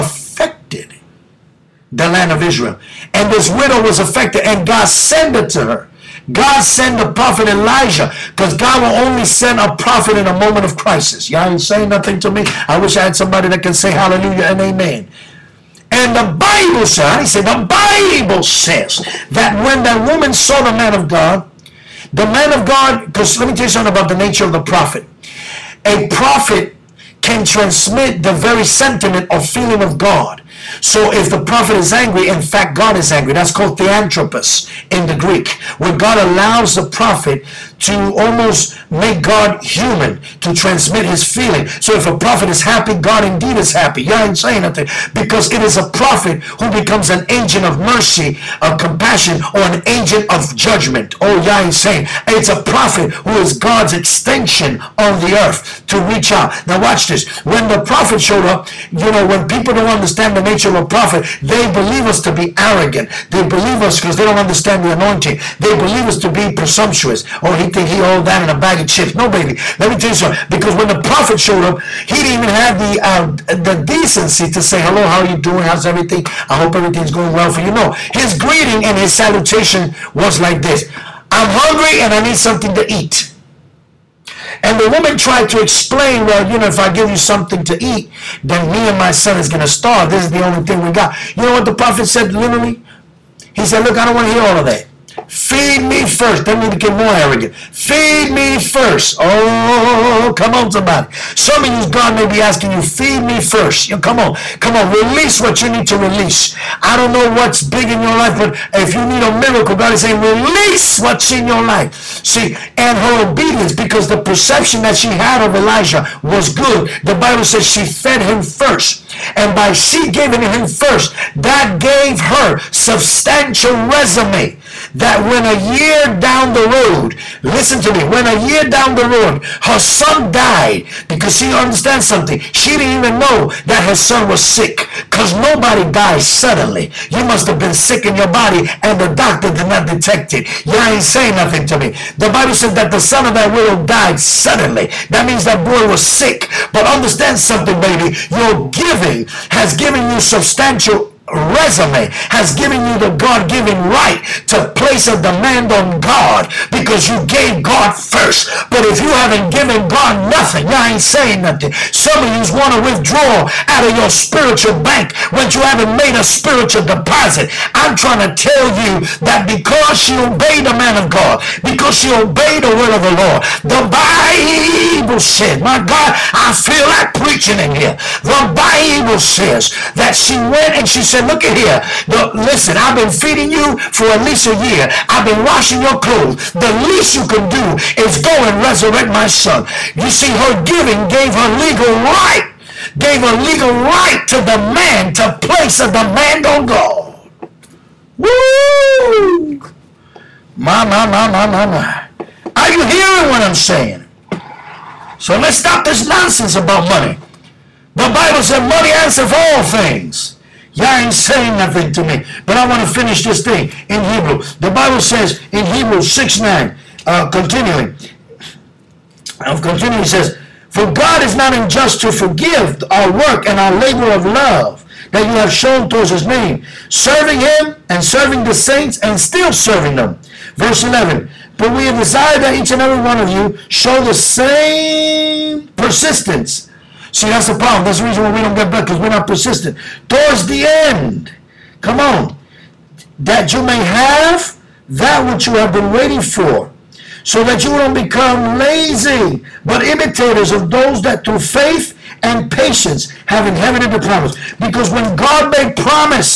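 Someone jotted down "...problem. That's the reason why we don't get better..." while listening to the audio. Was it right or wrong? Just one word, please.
right.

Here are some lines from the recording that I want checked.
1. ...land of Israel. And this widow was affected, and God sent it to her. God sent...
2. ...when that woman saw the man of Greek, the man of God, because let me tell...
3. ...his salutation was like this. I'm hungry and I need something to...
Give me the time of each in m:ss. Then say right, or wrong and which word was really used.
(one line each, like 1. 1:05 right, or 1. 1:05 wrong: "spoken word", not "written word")
1. 0:02 right
2. 0:19 wrong: "God", not "Greek"
3. 1:18 right.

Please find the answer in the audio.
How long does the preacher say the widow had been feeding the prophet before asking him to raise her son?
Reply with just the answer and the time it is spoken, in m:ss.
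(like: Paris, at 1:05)
at least a year, at 3:04.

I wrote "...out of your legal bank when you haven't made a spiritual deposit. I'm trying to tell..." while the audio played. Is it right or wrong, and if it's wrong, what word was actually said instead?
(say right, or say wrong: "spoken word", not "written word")
wrong: "spiritual", not "legal".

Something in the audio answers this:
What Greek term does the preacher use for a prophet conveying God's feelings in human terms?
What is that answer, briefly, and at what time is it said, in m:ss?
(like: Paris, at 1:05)
theanthropos, at 0:33.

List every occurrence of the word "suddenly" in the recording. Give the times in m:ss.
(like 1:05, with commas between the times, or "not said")
2:16, 2:24.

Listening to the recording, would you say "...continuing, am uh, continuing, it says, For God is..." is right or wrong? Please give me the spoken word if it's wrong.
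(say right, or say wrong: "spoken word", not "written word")
right.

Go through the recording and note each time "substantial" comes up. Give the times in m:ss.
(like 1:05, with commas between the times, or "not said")
2:02, 2:30.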